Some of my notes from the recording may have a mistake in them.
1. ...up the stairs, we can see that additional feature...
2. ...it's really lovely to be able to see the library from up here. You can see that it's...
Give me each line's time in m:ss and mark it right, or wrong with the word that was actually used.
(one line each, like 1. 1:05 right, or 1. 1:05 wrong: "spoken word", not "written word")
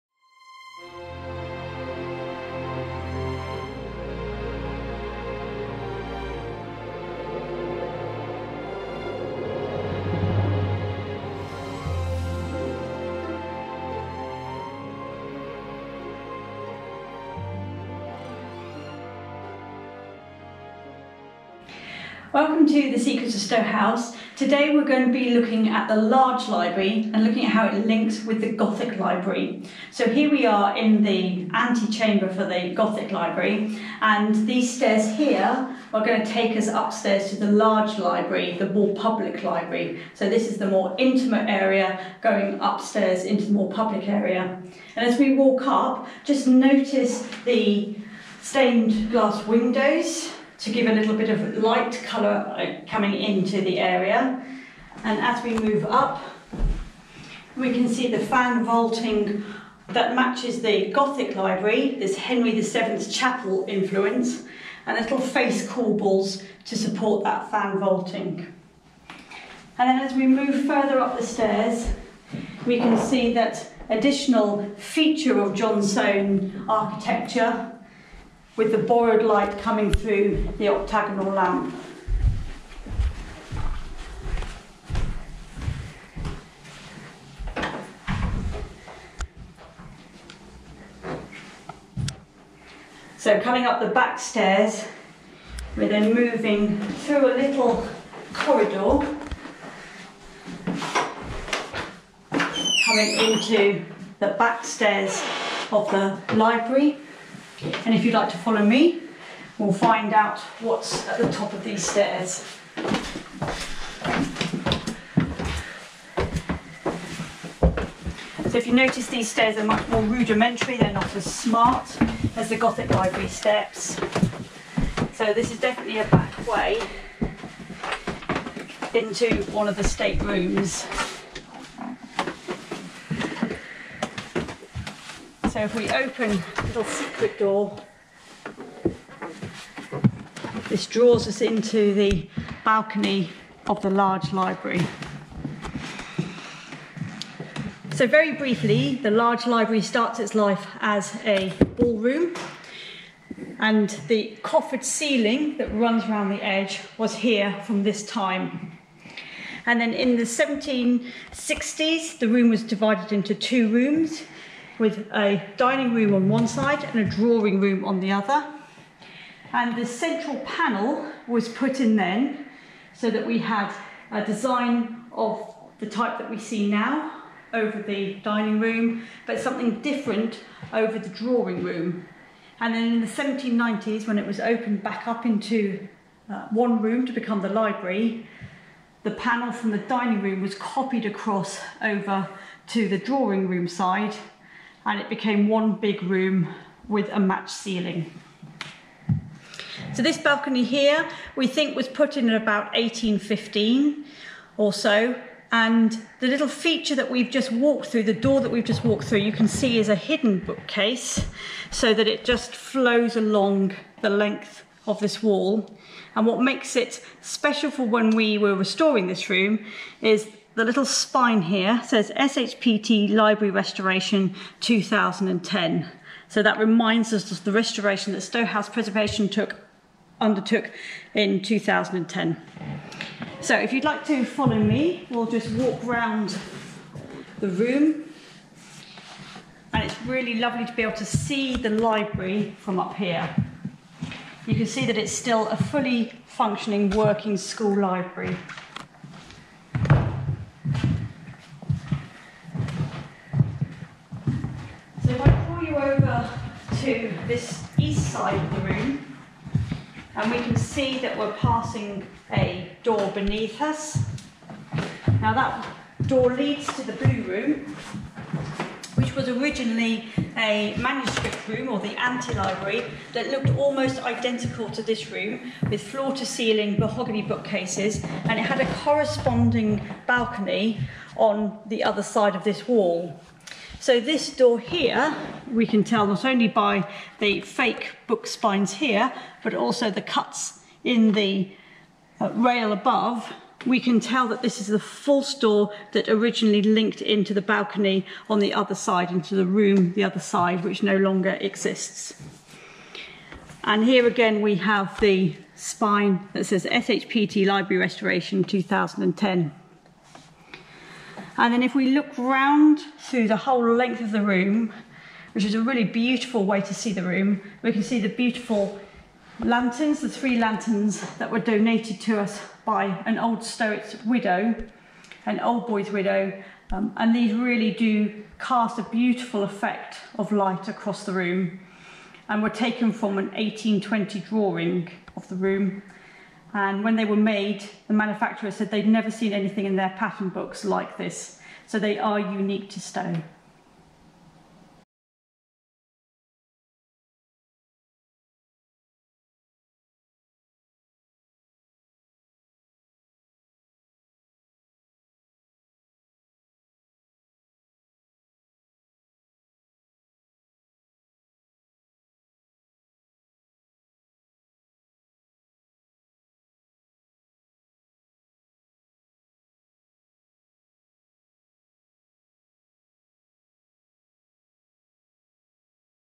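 1. 1:10 right
2. 3:59 right.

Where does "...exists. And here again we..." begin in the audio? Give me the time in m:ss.
5:01.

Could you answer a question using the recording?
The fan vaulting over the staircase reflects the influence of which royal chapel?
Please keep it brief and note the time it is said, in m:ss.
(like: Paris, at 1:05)
Henry VII's chapel, at 1:02.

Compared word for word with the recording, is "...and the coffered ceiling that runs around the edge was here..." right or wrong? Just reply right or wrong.
right.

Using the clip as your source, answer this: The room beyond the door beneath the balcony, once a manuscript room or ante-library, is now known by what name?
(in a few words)
The blue room.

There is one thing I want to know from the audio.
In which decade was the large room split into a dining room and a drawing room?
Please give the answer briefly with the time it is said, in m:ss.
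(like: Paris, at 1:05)
1760s, at 2:40.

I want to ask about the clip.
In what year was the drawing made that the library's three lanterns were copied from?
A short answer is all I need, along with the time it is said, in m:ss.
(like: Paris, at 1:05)
1820, at 5:33.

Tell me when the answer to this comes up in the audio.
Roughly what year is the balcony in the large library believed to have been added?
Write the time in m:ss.
3:22.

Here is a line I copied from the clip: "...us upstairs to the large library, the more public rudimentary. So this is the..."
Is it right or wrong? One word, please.
wrong.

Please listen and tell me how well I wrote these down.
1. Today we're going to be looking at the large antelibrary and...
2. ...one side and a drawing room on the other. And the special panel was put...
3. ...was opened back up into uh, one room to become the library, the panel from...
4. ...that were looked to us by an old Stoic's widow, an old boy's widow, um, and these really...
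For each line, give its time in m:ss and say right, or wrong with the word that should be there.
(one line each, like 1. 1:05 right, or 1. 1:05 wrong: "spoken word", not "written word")
1. 0:24 wrong: "library", not "antelibrary"
2. 2:46 wrong: "central", not "special"
3. 3:04 right
4. 5:21 wrong: "donated", not "looked".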